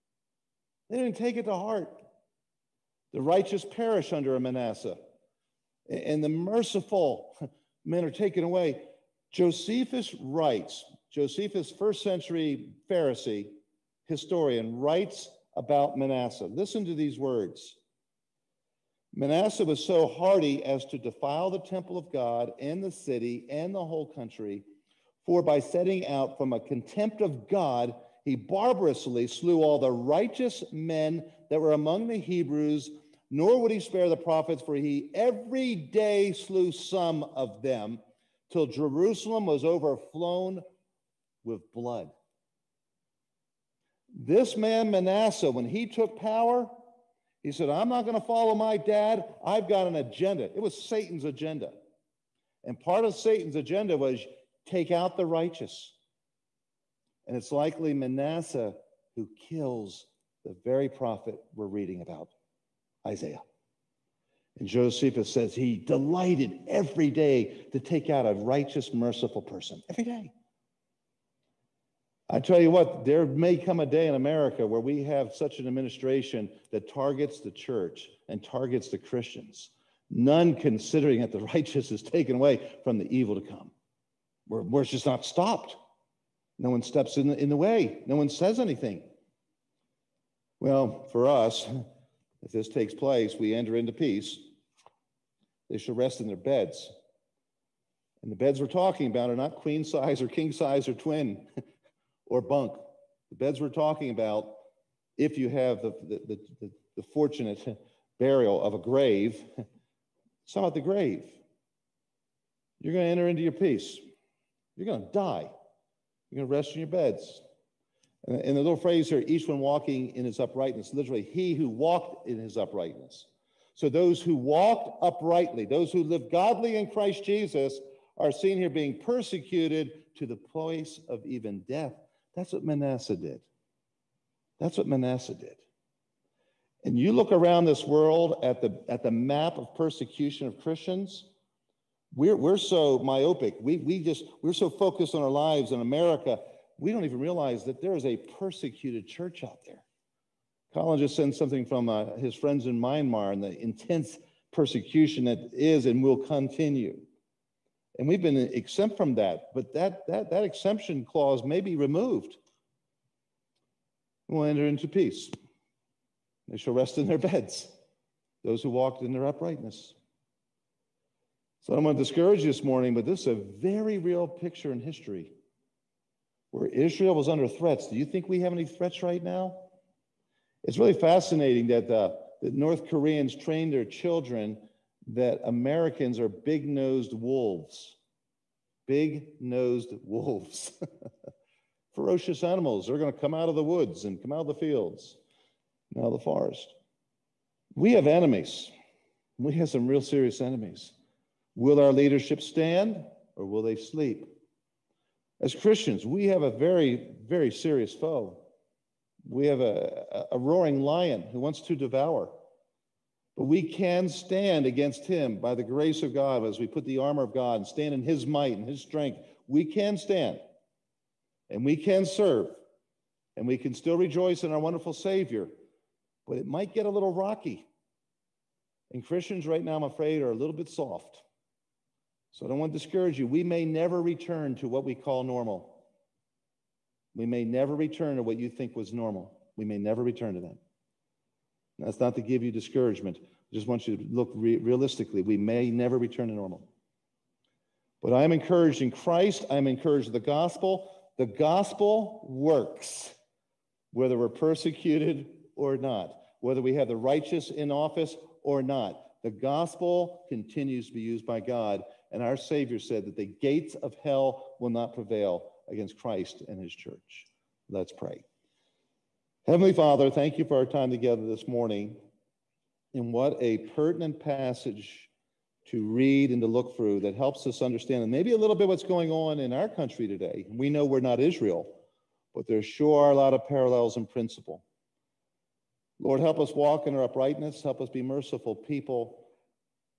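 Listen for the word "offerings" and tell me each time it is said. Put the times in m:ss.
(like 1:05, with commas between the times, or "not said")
not said.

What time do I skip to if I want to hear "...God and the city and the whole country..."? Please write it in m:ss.
0:22.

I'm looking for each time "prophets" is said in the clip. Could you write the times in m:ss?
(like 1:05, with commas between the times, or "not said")
0:34, 1:00.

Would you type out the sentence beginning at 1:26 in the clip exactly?
No one steps in the, in the way, no one says anything.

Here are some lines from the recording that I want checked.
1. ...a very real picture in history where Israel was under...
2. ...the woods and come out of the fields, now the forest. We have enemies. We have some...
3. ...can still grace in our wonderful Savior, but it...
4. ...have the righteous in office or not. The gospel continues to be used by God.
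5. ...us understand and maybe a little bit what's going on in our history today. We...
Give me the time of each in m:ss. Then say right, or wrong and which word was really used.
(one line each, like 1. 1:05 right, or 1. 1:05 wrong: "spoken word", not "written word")
1. 2:53 right
2. 3:13 right
3. 3:43 wrong: "rejoice", not "grace"
4. 4:16 right
5. 4:37 wrong: "country", not "history".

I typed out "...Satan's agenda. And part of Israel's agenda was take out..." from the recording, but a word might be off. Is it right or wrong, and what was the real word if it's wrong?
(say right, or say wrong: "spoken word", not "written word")
wrong: "Satan", not "Israel".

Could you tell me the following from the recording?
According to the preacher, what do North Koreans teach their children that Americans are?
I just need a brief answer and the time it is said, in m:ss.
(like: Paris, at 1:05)
Big nosed wolves, at 3:06.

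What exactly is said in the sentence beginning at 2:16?
And you look around this world at the, at the map of persecution of Christians, we're, we're so myopic.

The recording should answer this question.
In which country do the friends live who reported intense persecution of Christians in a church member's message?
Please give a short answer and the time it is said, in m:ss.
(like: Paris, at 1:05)
Myanmar, at 2:32.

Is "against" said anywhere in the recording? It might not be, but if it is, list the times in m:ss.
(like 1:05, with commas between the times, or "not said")
3:34, 4:25.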